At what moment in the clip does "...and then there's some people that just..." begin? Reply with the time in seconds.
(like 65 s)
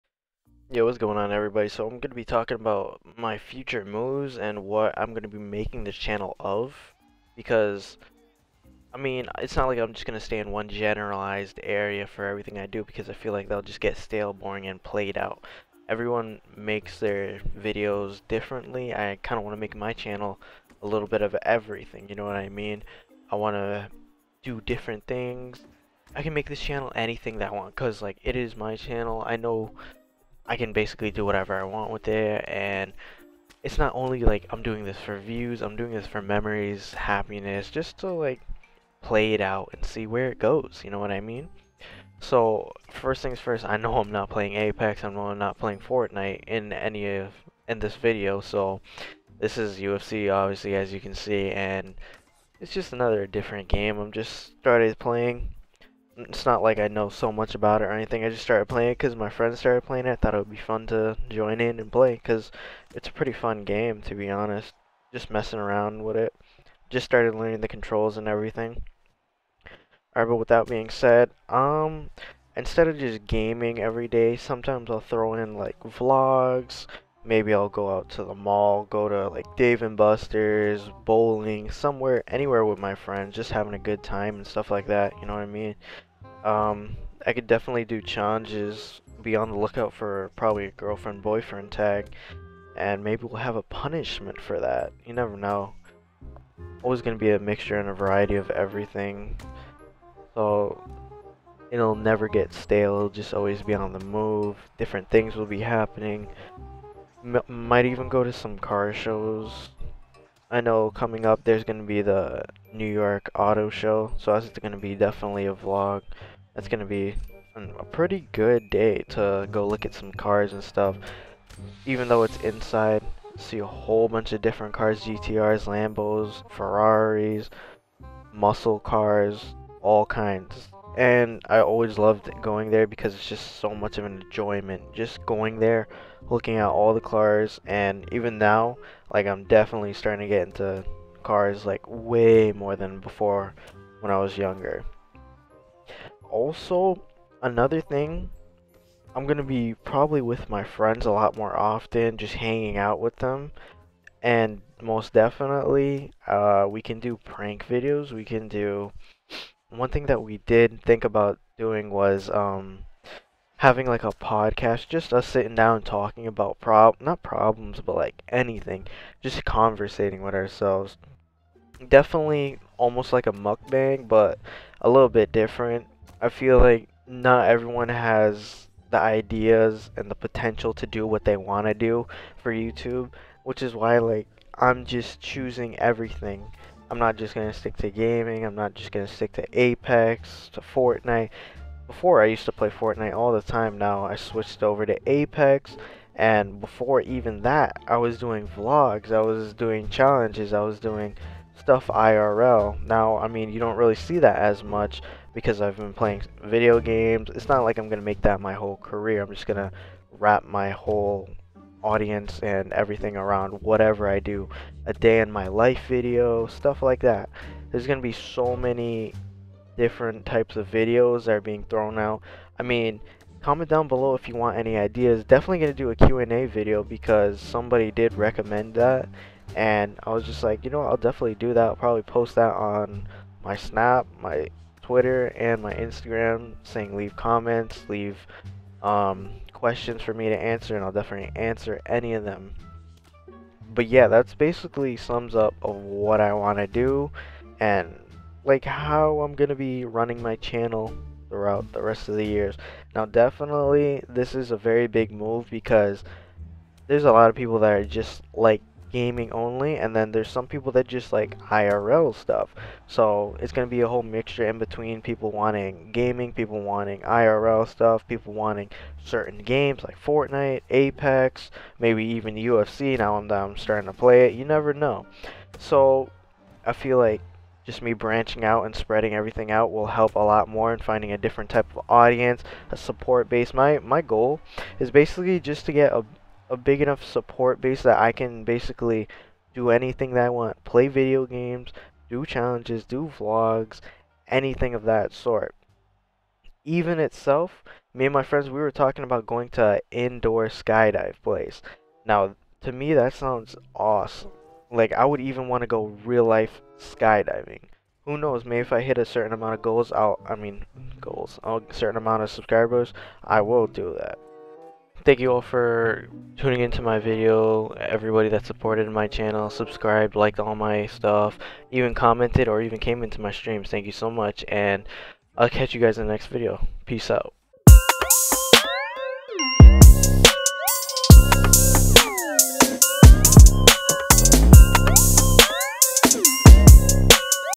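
259 s.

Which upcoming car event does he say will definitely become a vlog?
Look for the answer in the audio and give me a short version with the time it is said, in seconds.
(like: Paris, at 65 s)
New York Auto Show, at 112 s.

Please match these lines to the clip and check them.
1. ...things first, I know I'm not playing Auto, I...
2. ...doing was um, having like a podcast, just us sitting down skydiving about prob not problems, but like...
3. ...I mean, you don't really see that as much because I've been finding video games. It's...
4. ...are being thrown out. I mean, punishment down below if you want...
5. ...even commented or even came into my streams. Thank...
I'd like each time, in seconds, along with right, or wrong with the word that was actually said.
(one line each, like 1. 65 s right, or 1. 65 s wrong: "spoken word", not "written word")
1. 43 s wrong: "Apex", not "Auto"
2. 161 s wrong: "talking", not "skydiving"
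3. 203 s wrong: "playing", not "finding"
4. 221 s wrong: "comment", not "punishment"
5. 321 s right.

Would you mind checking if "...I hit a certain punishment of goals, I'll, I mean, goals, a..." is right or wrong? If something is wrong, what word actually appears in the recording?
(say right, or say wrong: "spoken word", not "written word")
wrong: "amount", not "punishment".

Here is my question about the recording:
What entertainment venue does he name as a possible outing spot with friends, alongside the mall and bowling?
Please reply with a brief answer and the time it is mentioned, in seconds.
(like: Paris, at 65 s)
Dave and Buster's, at 79 s.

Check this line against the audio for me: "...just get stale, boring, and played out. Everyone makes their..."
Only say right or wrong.
right.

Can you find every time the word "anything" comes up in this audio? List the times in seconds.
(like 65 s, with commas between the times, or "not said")
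26 s, 57 s, 168 s, 289 s, 294 s.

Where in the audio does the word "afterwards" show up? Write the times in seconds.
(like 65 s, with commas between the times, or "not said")
not said.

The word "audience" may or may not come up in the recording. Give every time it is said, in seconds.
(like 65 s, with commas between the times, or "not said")
211 s, 281 s.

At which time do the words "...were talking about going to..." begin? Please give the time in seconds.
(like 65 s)
298 s.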